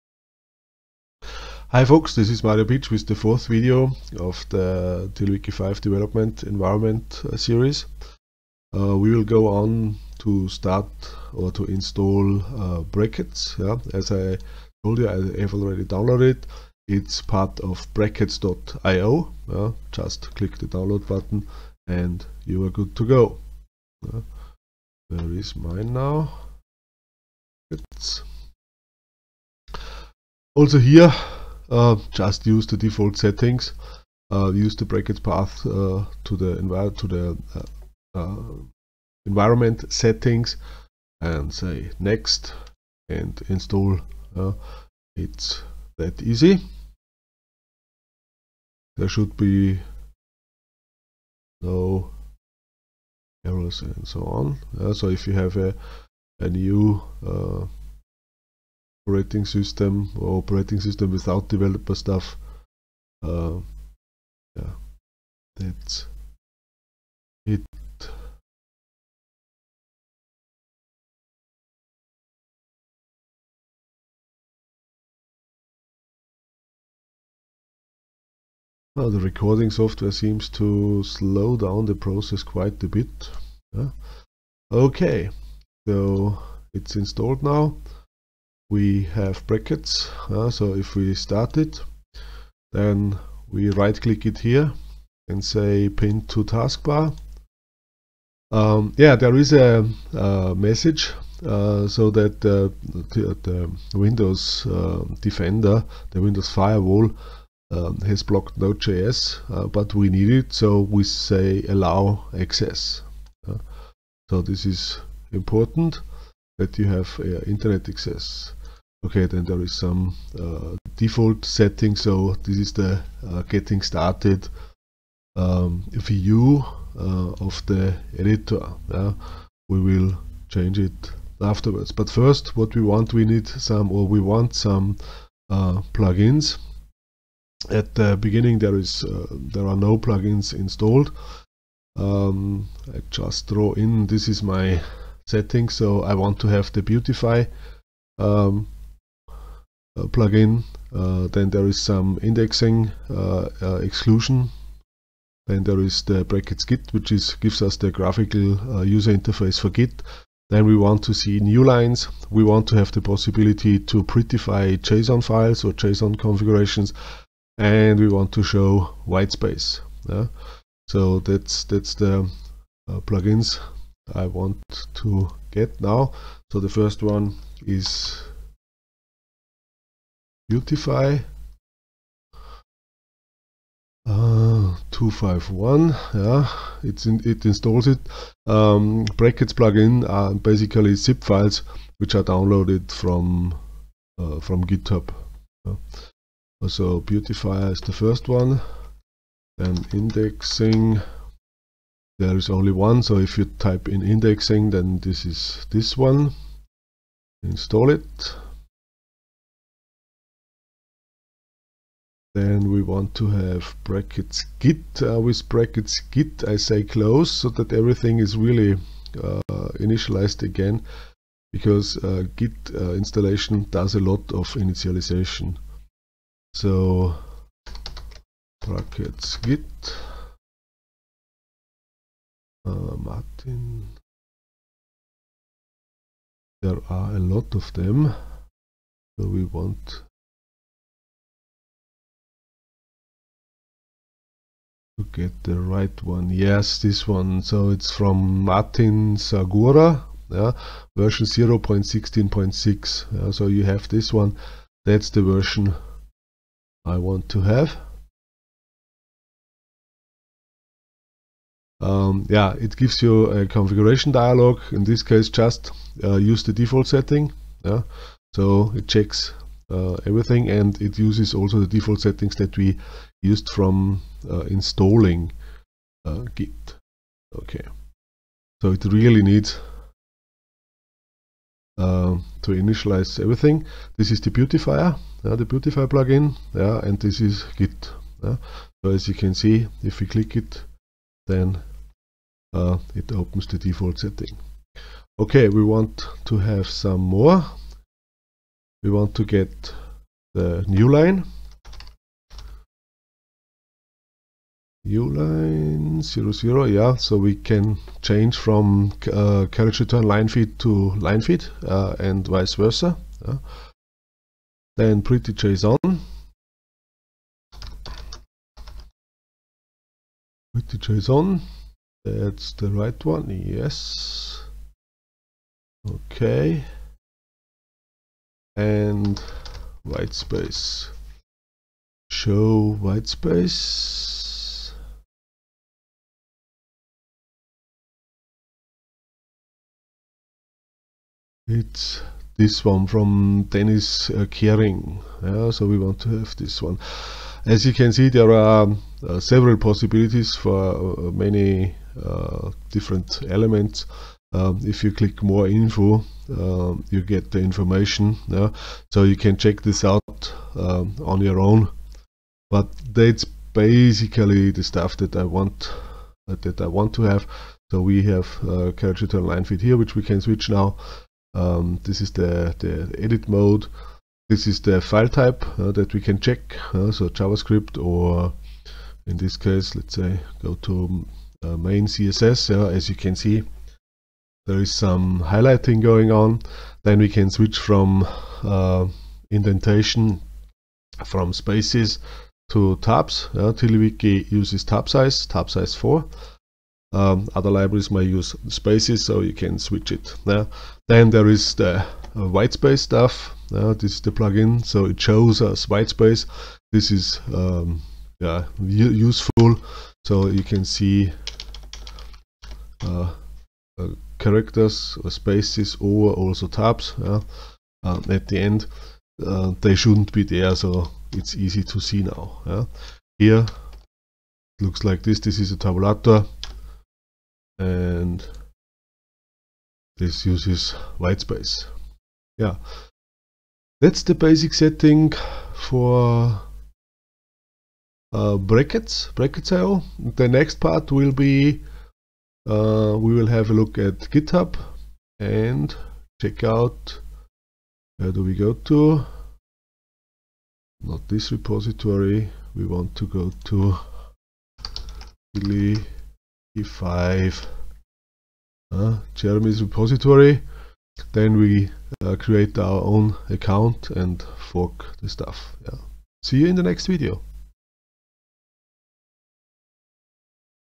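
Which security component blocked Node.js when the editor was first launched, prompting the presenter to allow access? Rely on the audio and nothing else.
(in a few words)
Windows Firewall.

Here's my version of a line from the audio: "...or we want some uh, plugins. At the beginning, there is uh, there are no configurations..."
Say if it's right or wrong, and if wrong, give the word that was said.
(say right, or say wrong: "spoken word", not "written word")
wrong: "plugins", not "configurations".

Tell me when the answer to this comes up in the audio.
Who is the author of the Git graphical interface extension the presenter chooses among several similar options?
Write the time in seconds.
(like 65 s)
248 s.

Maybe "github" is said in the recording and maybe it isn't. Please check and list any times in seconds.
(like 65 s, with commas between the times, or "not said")
194 s, 444 s.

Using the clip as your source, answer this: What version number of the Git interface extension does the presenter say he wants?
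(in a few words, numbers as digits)
0.16.6.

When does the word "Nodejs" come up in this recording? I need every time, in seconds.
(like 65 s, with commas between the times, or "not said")
108 s.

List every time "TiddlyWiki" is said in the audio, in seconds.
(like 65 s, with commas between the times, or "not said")
5 s, 393 s.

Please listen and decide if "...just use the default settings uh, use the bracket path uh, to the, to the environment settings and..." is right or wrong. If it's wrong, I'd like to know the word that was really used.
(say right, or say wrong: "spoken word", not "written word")
right.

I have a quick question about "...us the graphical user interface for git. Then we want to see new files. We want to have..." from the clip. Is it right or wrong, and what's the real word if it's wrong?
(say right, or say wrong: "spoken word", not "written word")
wrong: "lines", not "files".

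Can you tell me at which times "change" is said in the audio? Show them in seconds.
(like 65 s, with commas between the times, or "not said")
130 s, 308 s.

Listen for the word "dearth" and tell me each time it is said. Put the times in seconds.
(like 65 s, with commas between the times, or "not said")
not said.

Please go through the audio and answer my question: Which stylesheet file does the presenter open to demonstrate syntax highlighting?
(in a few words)
main CSS.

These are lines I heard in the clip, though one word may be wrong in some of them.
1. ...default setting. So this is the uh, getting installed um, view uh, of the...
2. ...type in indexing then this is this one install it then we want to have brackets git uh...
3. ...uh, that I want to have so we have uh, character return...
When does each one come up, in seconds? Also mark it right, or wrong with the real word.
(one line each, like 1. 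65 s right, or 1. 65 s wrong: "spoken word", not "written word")
1. 120 s wrong: "started", not "installed"
2. 203 s right
3. 366 s right.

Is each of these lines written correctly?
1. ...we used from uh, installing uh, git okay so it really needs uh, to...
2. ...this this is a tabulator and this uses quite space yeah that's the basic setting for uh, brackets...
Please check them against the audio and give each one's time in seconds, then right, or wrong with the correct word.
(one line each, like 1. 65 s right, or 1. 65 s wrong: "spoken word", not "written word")
1. 272 s right
2. 425 s wrong: "white", not "quite".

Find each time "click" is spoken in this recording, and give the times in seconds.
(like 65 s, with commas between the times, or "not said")
20 s, 94 s, 290 s, 354 s.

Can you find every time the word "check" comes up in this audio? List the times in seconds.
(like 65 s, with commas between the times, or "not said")
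268 s, 359 s, 376 s, 446 s.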